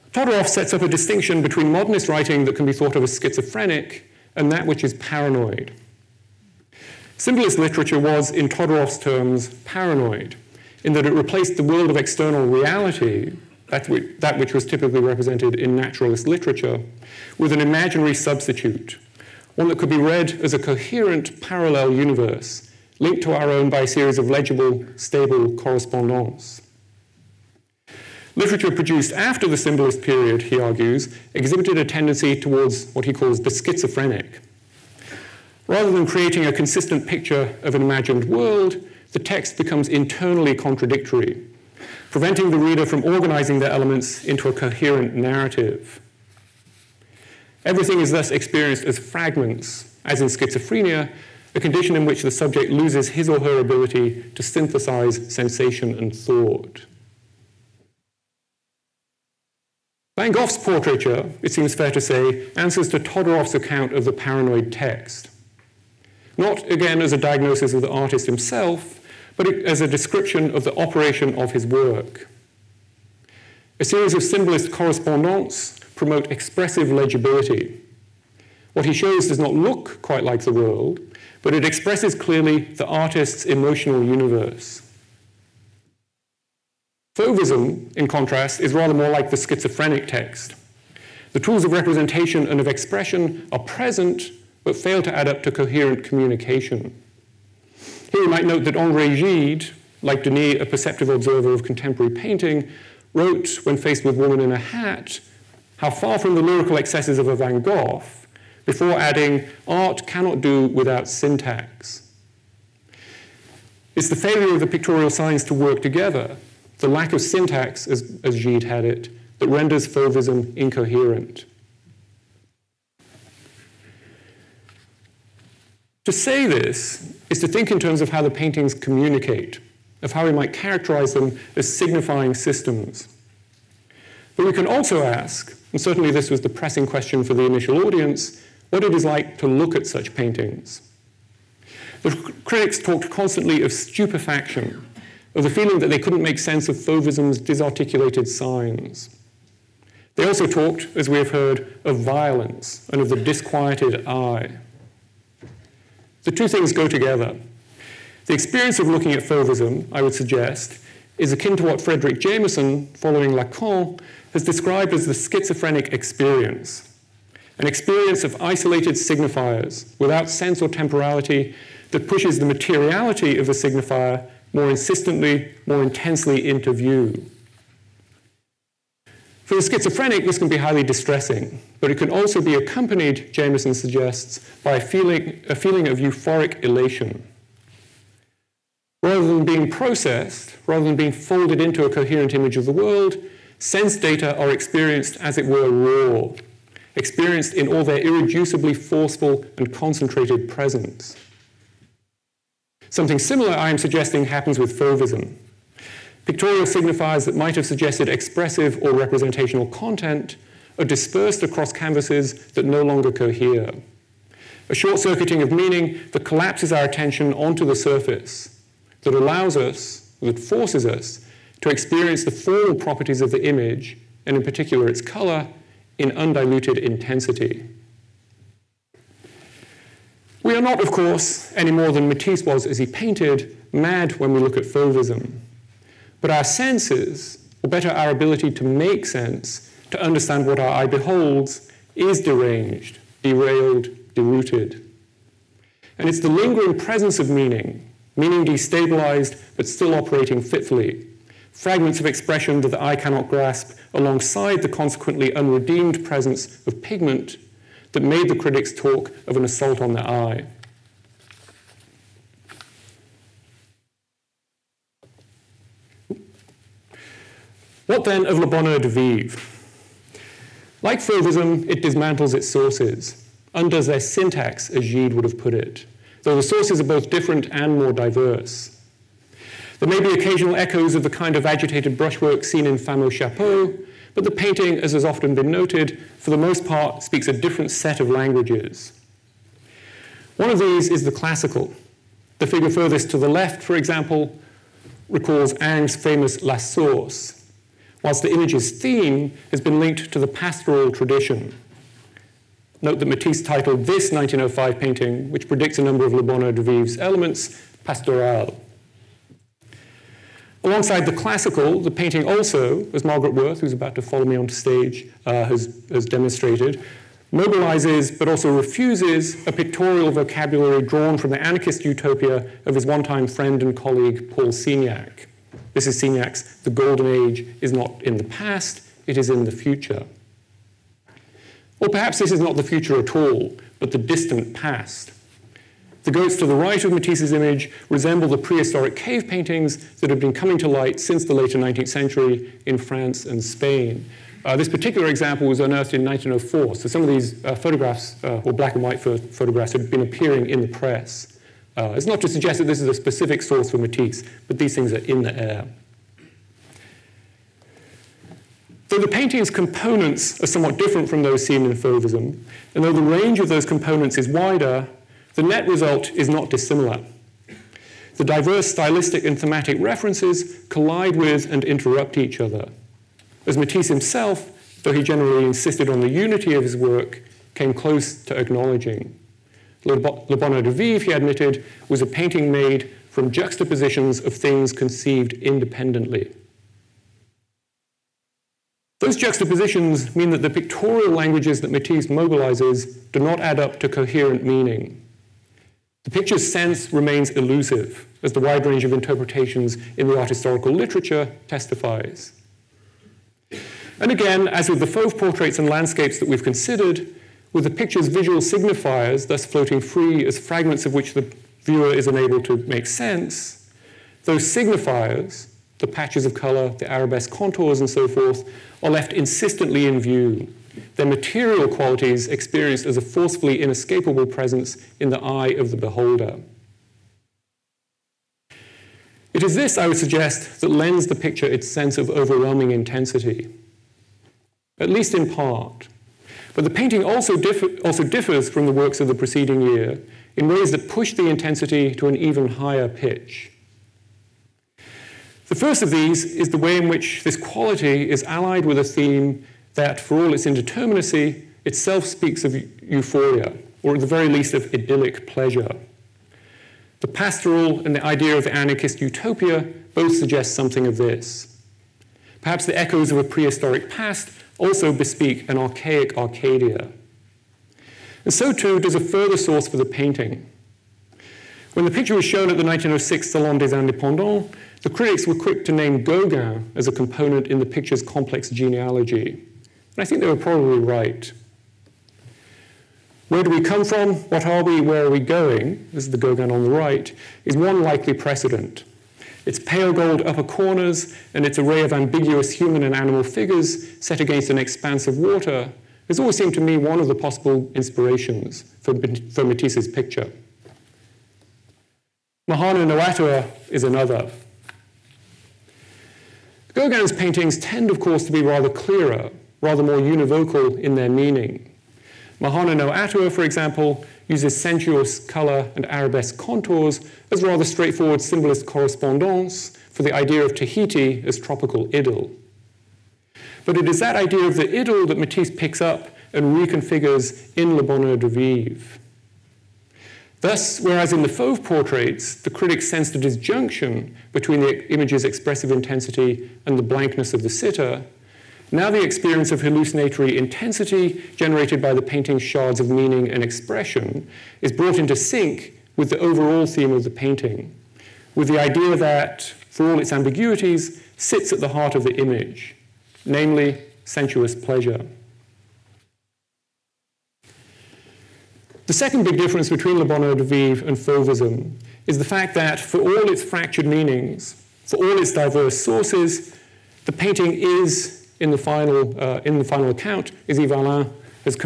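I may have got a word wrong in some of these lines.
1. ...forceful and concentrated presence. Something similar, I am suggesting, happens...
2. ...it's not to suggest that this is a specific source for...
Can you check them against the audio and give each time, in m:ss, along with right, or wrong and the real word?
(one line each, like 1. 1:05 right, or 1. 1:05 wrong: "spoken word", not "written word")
1. 3:18 right
2. 5:51 right.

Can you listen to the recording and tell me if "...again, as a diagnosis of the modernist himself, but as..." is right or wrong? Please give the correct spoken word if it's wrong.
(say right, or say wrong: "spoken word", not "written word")
wrong: "artist", not "modernist".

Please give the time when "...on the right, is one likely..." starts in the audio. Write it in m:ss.
8:06.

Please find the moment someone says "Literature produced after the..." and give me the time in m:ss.
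0:28.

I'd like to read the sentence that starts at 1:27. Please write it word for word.
Fauvism, in contrast, is rather more like the schizophrenic text.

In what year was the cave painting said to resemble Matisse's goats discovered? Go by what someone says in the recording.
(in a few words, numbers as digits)
1904.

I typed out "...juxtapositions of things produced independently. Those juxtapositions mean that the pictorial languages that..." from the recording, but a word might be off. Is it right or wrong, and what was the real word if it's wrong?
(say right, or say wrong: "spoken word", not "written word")
wrong: "conceived", not "produced".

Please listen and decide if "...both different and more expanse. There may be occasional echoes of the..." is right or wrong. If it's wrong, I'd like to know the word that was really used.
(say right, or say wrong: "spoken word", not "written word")
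wrong: "diverse", not "expanse".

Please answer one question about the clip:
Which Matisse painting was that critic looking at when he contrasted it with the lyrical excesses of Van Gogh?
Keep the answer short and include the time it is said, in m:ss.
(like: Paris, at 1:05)
Woman in a Hat, at 1:44.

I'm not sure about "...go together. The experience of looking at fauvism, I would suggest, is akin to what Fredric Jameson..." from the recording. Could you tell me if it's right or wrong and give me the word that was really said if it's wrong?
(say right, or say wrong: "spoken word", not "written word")
right.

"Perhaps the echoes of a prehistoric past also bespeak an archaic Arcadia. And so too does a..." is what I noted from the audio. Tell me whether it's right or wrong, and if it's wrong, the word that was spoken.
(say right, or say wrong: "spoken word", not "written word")
right.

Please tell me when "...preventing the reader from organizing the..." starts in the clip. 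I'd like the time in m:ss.
0:42.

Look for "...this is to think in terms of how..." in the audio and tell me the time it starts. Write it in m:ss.
2:06.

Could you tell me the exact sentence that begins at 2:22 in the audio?
The critics talked constantly of stupefaction, of the feeling that they couldn't make sense of Fauvism's disarticulated signs.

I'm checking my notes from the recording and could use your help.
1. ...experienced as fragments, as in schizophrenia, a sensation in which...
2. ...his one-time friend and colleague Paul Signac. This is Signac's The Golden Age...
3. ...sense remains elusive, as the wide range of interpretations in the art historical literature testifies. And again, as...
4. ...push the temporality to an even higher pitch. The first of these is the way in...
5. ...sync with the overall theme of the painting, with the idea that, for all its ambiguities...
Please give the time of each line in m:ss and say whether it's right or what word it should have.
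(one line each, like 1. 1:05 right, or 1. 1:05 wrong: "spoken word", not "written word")
1. 0:48 wrong: "condition", not "sensation"
2. 5:22 right
3. 6:36 right
4. 7:20 wrong: "intensity", not "temporality"
5. 9:05 right.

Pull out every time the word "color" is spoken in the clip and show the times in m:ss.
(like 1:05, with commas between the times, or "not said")
3:45, 6:56, 8:35.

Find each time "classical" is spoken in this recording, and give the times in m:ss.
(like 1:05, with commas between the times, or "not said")
4:51, 5:11.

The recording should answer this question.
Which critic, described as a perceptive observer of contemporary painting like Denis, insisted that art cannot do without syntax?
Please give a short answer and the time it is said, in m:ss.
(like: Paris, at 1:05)
Henri Gide, at 1:38.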